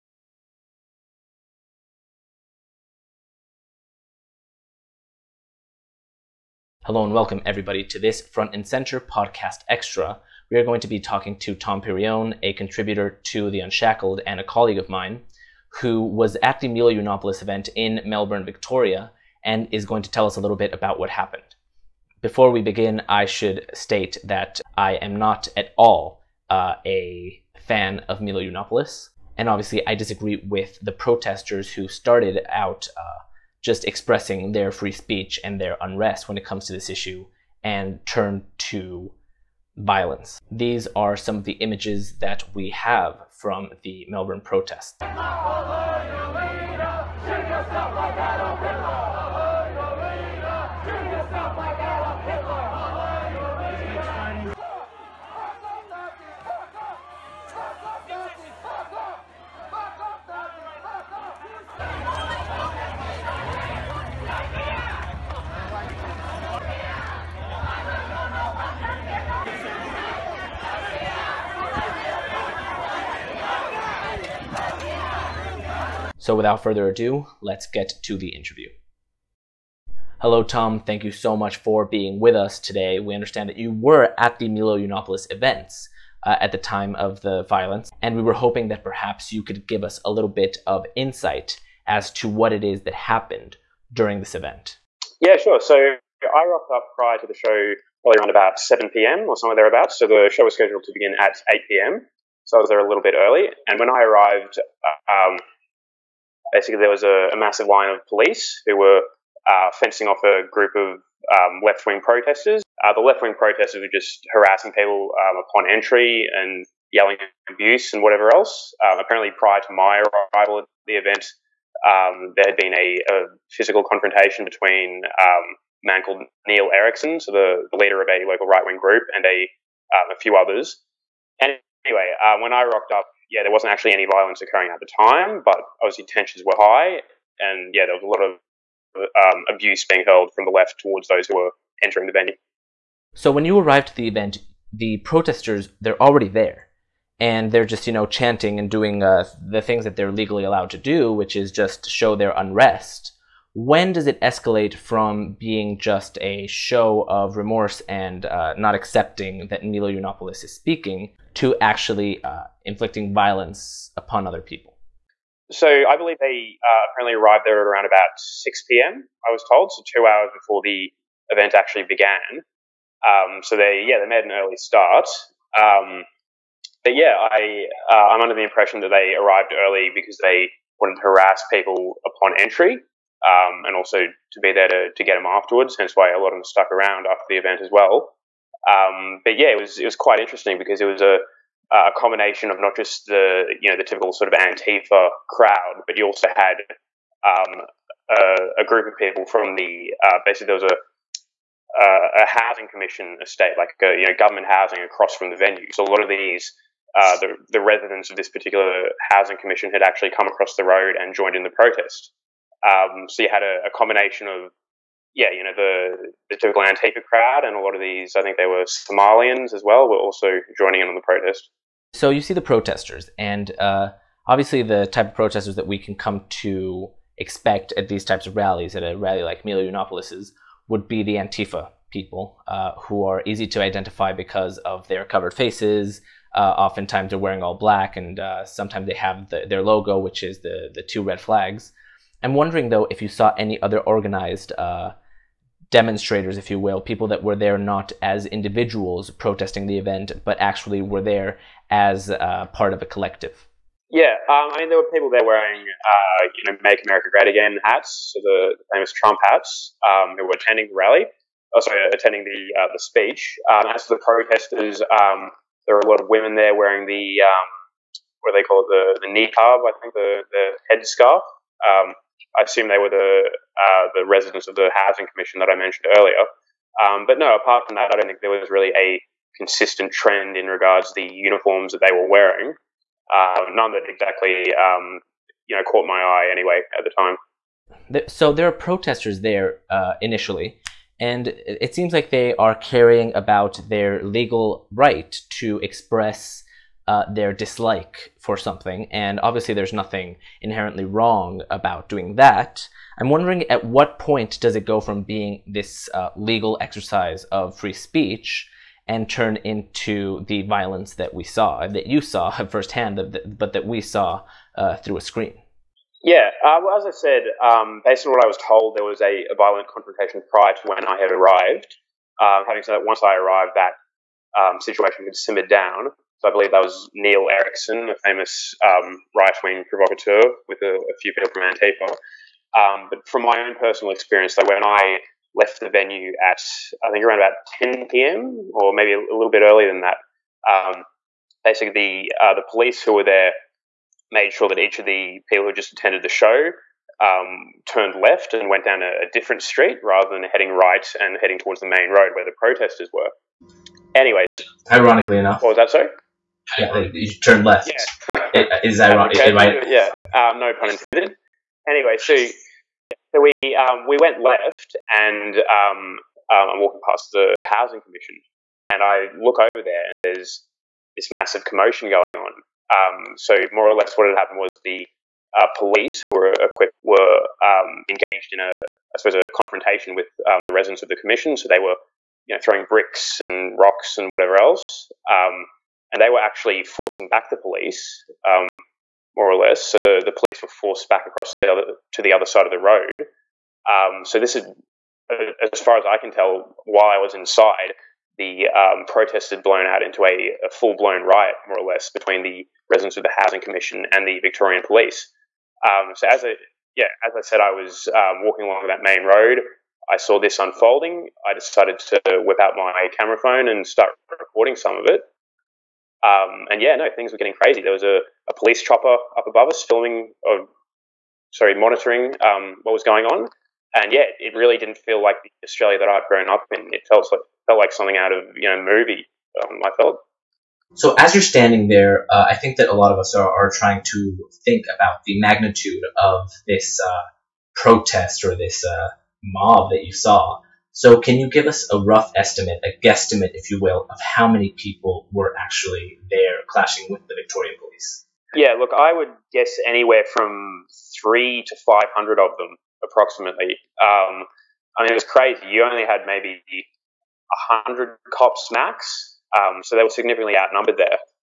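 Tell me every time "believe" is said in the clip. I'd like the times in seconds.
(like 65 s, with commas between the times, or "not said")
165 s, 326 s.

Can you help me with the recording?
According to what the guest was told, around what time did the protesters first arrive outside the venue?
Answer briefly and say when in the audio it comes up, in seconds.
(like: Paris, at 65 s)
6 p.m., at 168 s.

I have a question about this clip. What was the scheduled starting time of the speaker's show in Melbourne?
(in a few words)
8 p.m.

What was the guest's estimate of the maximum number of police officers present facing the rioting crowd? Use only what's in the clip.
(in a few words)
100.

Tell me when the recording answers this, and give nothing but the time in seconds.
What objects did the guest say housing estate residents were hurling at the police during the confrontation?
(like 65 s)
382 s.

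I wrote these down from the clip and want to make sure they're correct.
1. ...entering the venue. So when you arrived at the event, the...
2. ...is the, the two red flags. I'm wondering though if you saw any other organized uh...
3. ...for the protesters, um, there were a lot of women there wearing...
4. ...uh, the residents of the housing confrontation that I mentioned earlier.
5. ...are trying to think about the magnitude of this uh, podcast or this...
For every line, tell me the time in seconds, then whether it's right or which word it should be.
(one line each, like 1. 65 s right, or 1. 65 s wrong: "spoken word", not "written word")
1. 141 s right
2. 240 s right
3. 263 s right
4. 273 s wrong: "commission", not "confrontation"
5. 433 s wrong: "protest", not "podcast".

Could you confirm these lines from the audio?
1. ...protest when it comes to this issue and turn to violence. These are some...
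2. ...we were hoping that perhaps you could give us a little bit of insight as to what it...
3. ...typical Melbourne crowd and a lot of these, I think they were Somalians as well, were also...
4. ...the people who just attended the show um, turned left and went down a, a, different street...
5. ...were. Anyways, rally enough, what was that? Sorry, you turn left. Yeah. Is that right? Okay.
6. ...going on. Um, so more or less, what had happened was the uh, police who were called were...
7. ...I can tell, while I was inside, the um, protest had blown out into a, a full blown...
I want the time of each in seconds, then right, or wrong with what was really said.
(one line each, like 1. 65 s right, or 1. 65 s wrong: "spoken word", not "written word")
1. 35 s wrong: "unrest", not "protest"
2. 88 s right
3. 216 s wrong: "Antifa", not "Melbourne"
4. 344 s right
5. 352 s wrong: "ironically", not "rally"
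6. 371 s wrong: "equipped", not "called"
7. 395 s right.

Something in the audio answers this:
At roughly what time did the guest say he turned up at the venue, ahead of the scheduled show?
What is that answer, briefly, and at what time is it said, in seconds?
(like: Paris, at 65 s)
7 p.m., at 98 s.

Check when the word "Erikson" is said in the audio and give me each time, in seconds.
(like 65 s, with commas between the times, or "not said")
126 s, 327 s.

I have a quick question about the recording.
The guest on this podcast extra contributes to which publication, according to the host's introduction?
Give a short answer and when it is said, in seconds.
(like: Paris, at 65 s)
The Unshackled, at 13 s.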